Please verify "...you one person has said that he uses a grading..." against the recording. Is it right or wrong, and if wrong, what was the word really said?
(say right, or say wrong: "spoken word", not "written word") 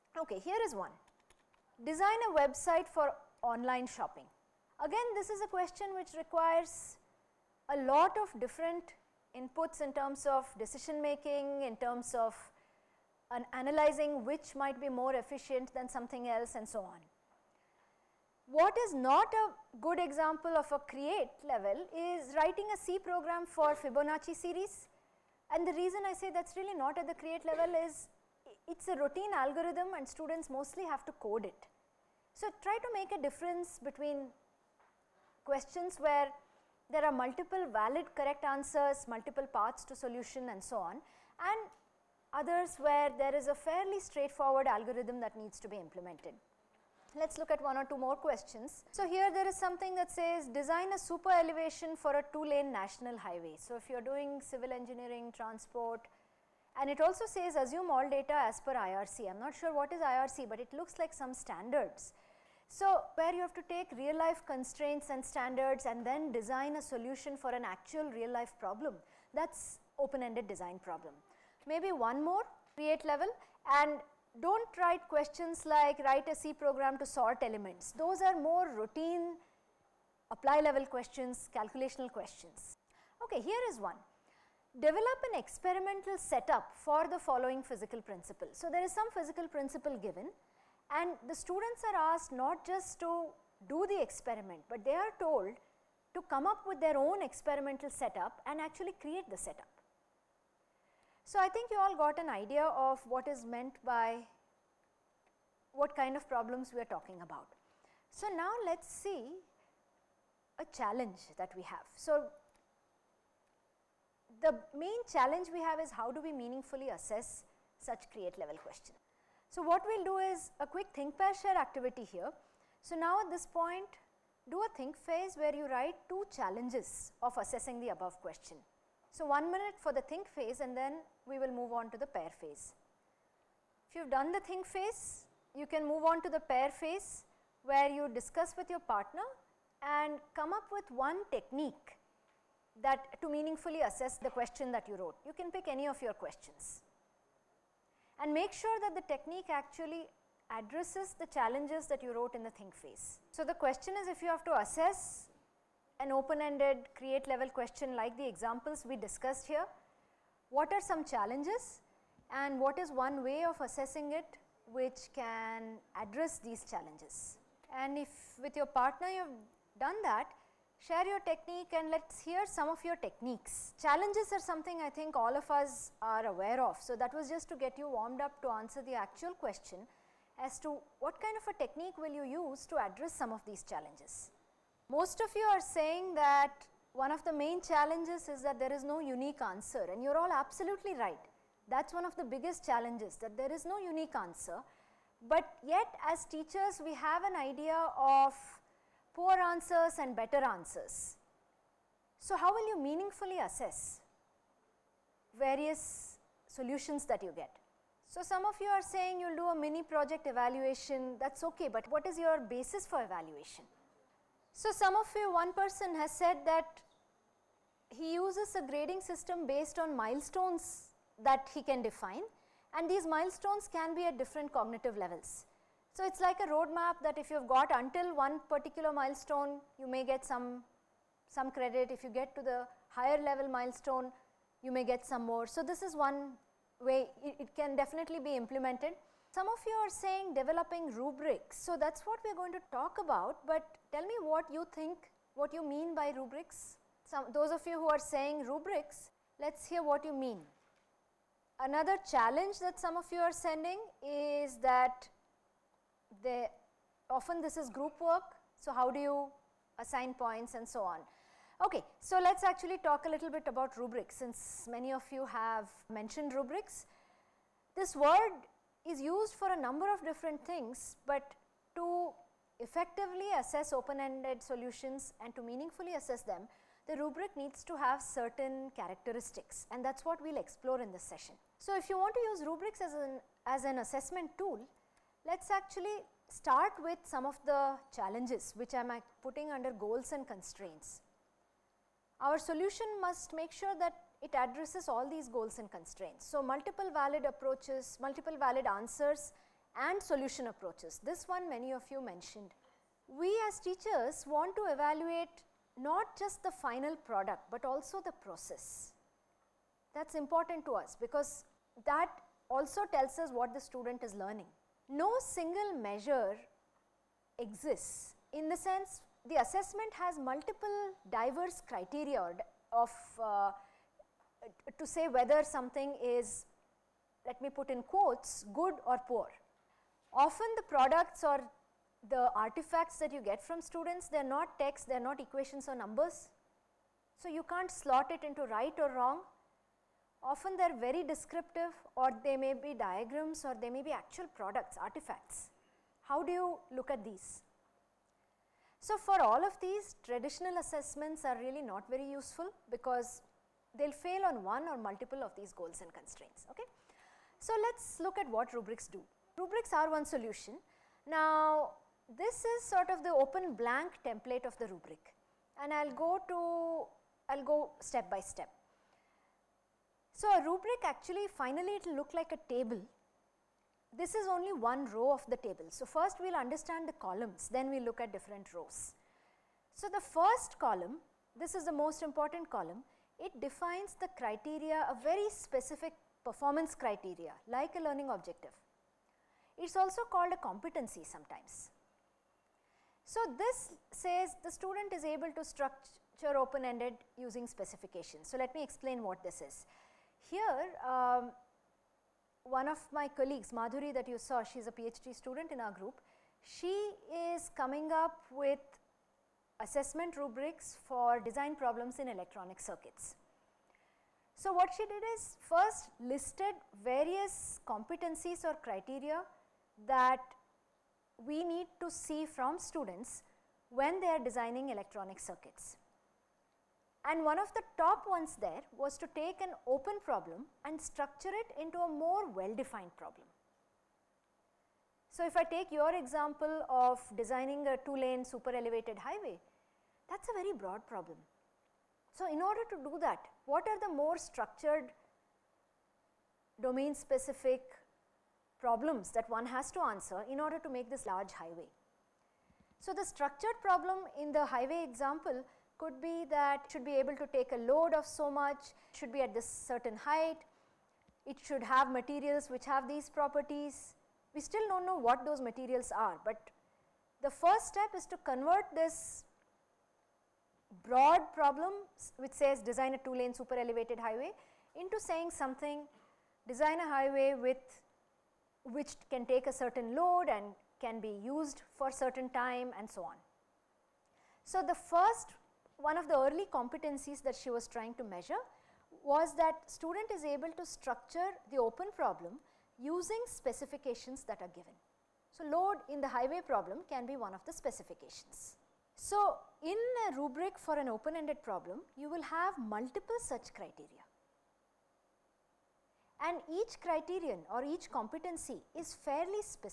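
right.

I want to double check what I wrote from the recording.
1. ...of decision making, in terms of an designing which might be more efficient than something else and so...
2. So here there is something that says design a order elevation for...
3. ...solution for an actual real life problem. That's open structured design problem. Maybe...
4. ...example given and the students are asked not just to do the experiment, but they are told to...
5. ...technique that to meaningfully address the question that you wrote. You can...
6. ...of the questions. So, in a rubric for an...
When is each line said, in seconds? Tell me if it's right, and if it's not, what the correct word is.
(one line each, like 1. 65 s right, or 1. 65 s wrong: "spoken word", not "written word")
1. 10 s wrong: "analyzing", not "designing"
2. 48 s wrong: "super", not "order"
3. 66 s wrong: "ended", not "structured"
4. 89 s wrong: "principle", not "example"
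5. 141 s wrong: "assess", not "address"
6. 497 s wrong: "specifications", not "questions".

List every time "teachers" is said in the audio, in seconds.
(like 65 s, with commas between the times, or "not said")
196 s, 303 s.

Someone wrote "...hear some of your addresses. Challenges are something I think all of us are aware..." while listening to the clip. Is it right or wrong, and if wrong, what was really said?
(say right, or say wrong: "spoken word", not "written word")
wrong: "techniques", not "addresses".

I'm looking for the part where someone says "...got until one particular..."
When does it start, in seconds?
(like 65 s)
227 s.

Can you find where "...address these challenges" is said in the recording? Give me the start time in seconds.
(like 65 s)
165 s.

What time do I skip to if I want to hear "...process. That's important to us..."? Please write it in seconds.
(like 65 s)
308 s.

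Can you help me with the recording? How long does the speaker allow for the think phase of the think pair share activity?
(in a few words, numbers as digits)
1 minute.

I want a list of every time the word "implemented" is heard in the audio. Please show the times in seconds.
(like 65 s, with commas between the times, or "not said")
45 s, 238 s.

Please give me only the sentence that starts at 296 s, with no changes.
So multiple valid approaches, multiple valid answers and solution approaches.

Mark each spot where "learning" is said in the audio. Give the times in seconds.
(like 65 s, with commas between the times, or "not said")
314 s, 387 s.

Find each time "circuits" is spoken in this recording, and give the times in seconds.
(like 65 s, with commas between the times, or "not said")
412 s, 425 s.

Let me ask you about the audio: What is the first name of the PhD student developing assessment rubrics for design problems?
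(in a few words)
Madhuri.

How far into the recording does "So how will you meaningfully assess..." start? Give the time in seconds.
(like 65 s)
202 s.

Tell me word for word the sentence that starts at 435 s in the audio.
So, if I take your example of designing a two lane super elevated highway, that is a very broad problem.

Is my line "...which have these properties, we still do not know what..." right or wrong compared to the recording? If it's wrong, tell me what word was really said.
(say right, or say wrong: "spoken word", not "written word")
right.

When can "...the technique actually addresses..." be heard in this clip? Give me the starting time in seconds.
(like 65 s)
148 s.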